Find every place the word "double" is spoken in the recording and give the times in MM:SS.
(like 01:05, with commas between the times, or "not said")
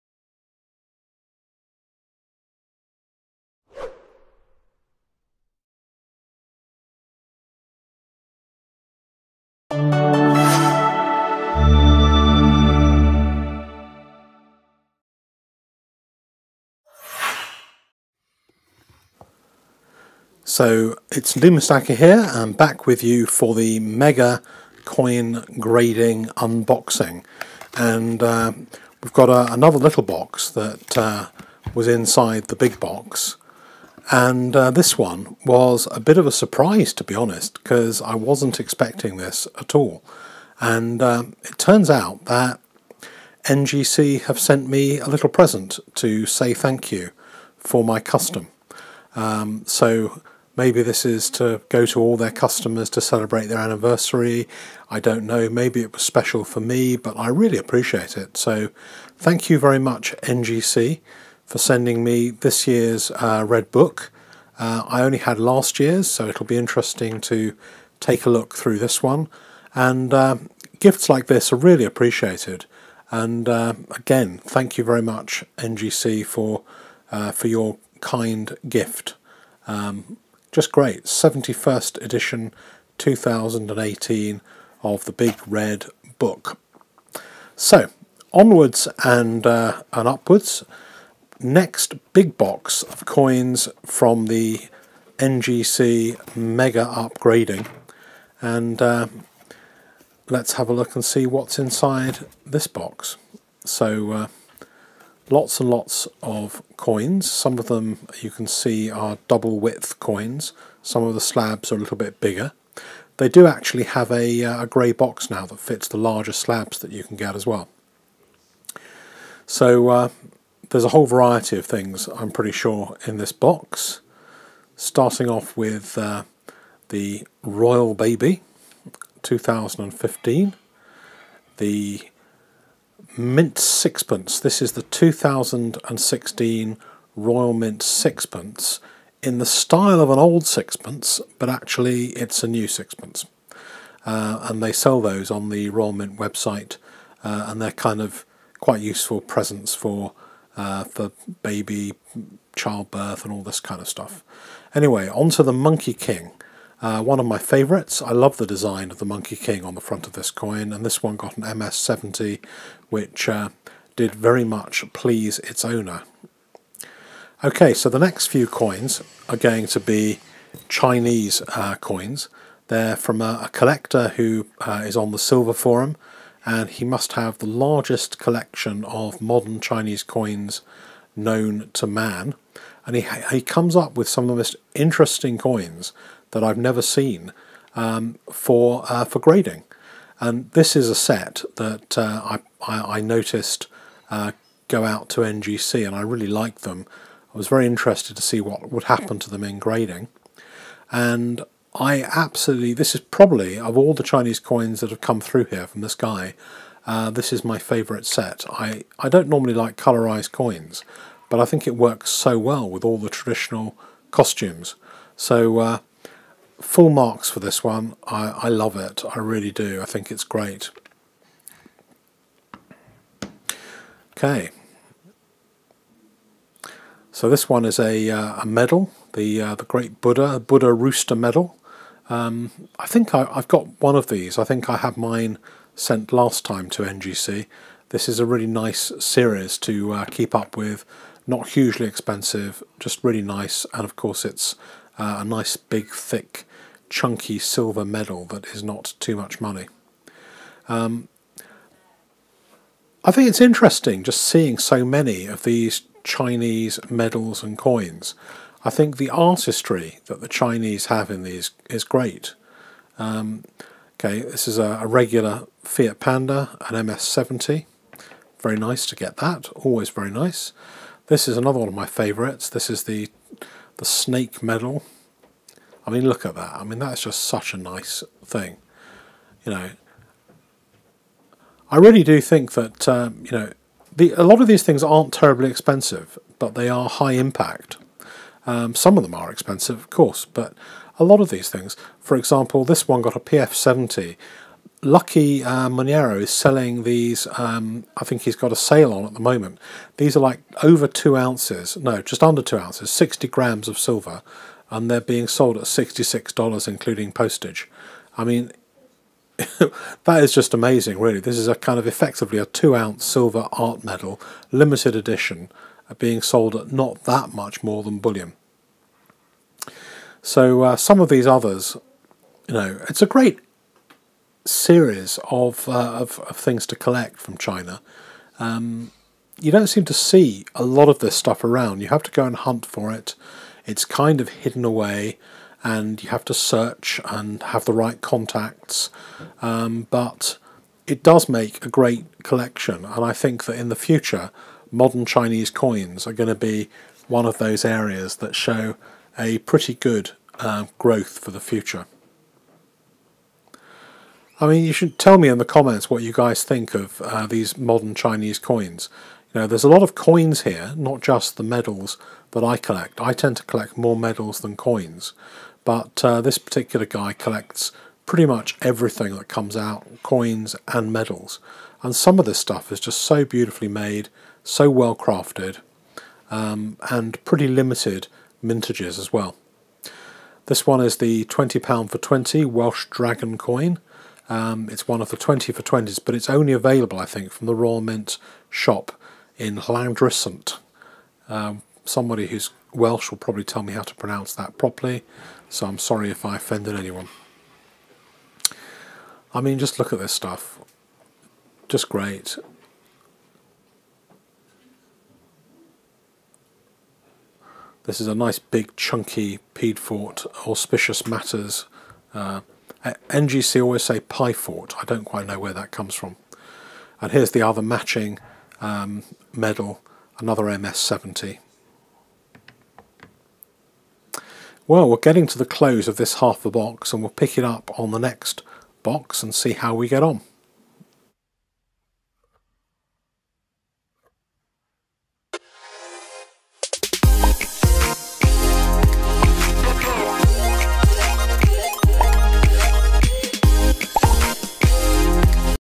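01:49.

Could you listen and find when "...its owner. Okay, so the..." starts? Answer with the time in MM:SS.
02:45.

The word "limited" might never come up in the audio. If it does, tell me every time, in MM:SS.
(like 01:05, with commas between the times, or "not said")
05:14, 06:17.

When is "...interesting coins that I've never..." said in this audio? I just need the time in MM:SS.
03:04.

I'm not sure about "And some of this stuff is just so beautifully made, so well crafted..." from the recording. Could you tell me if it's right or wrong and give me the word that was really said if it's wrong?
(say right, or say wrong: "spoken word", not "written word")
right.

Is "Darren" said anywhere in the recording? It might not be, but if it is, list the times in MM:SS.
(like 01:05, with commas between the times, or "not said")
not said.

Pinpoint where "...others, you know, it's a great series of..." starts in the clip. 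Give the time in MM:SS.
05:21.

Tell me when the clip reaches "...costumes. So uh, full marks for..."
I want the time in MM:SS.
03:34.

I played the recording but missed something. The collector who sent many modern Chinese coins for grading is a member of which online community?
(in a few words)
Silver Forum.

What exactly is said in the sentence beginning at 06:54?
I don't quite know where that comes from.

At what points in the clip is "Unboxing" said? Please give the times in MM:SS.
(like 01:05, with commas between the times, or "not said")
00:26.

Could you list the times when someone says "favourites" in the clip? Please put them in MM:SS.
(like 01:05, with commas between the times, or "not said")
02:37, 03:27, 04:31.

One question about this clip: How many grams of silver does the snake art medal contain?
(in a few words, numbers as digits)
60 grams.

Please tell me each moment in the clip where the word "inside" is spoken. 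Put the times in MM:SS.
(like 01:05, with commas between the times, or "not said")
00:31, 01:41.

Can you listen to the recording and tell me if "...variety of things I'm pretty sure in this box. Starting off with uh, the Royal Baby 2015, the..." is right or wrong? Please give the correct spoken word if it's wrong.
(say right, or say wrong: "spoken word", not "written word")
right.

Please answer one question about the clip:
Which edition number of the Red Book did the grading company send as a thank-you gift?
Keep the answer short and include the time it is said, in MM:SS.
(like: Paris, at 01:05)
71st, at 01:21.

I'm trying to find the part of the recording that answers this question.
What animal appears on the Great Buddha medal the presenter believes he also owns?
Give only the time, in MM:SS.
03:50.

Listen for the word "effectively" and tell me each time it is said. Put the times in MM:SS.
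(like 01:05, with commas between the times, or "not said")
05:11.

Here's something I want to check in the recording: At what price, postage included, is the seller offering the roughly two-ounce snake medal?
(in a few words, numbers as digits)
$66.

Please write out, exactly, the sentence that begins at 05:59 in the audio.
You know, there's a lot of coins here, not just the medals that I collect.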